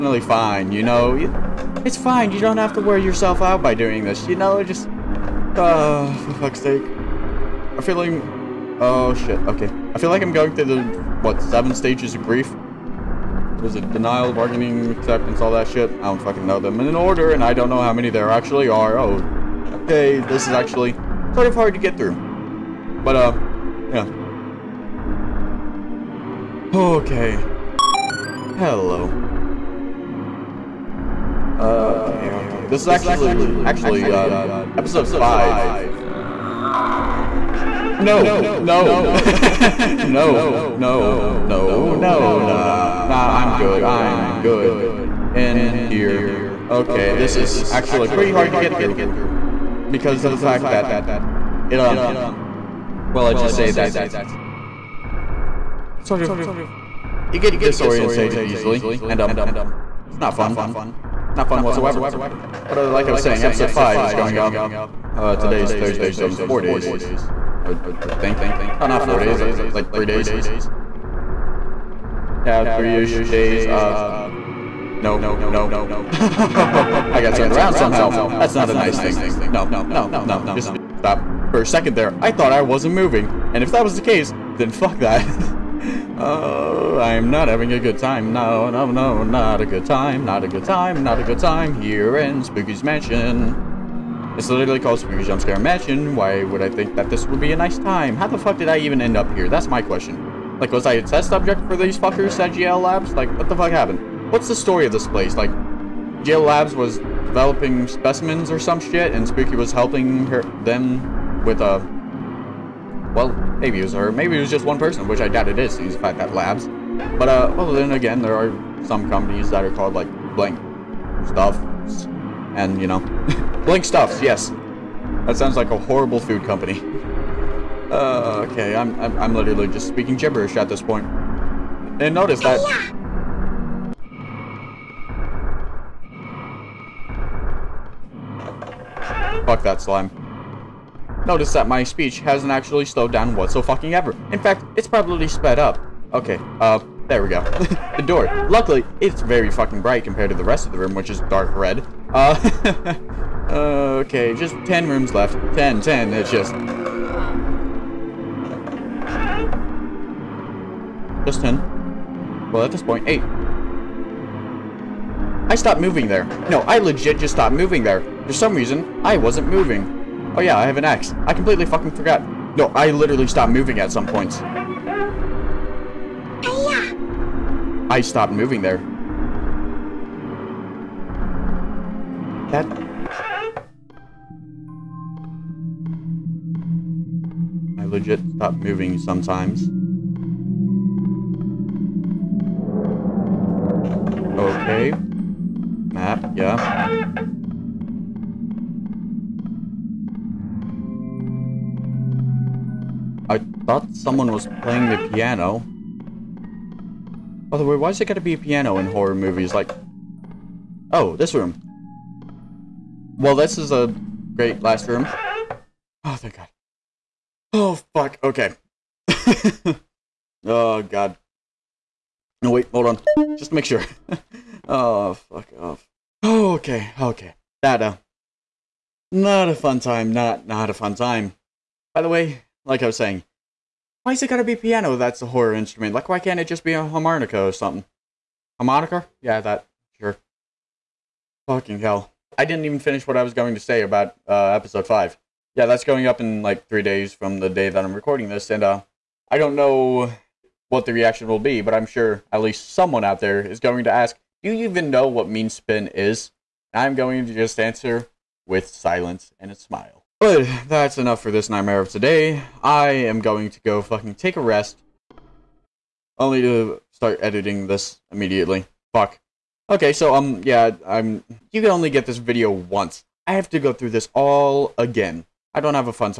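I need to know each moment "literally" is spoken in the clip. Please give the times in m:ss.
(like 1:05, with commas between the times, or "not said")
1:34, 2:09, 2:52.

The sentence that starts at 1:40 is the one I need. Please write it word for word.
Like, was I a test subject for these fuckers at GL Labs?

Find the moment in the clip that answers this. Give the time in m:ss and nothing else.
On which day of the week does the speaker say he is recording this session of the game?
1:05.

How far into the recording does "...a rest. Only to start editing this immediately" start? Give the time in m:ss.
4:24.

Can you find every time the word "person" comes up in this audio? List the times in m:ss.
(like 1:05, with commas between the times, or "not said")
1:54.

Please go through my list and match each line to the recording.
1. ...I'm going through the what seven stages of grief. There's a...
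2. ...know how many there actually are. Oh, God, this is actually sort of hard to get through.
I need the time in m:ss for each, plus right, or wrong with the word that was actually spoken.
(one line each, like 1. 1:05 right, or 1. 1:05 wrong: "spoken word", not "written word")
1. 0:10 right
2. 0:17 wrong: "Okay", not "God".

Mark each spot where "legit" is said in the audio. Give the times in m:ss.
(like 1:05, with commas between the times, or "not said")
2:46, 3:07.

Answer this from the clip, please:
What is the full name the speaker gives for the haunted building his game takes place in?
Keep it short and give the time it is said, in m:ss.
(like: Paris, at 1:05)
Spooky Jump Scare Mansion, at 1:34.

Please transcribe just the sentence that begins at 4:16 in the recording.
I'm going to just answer with silence and a smile.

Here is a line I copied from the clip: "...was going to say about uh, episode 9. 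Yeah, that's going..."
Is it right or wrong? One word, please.
wrong.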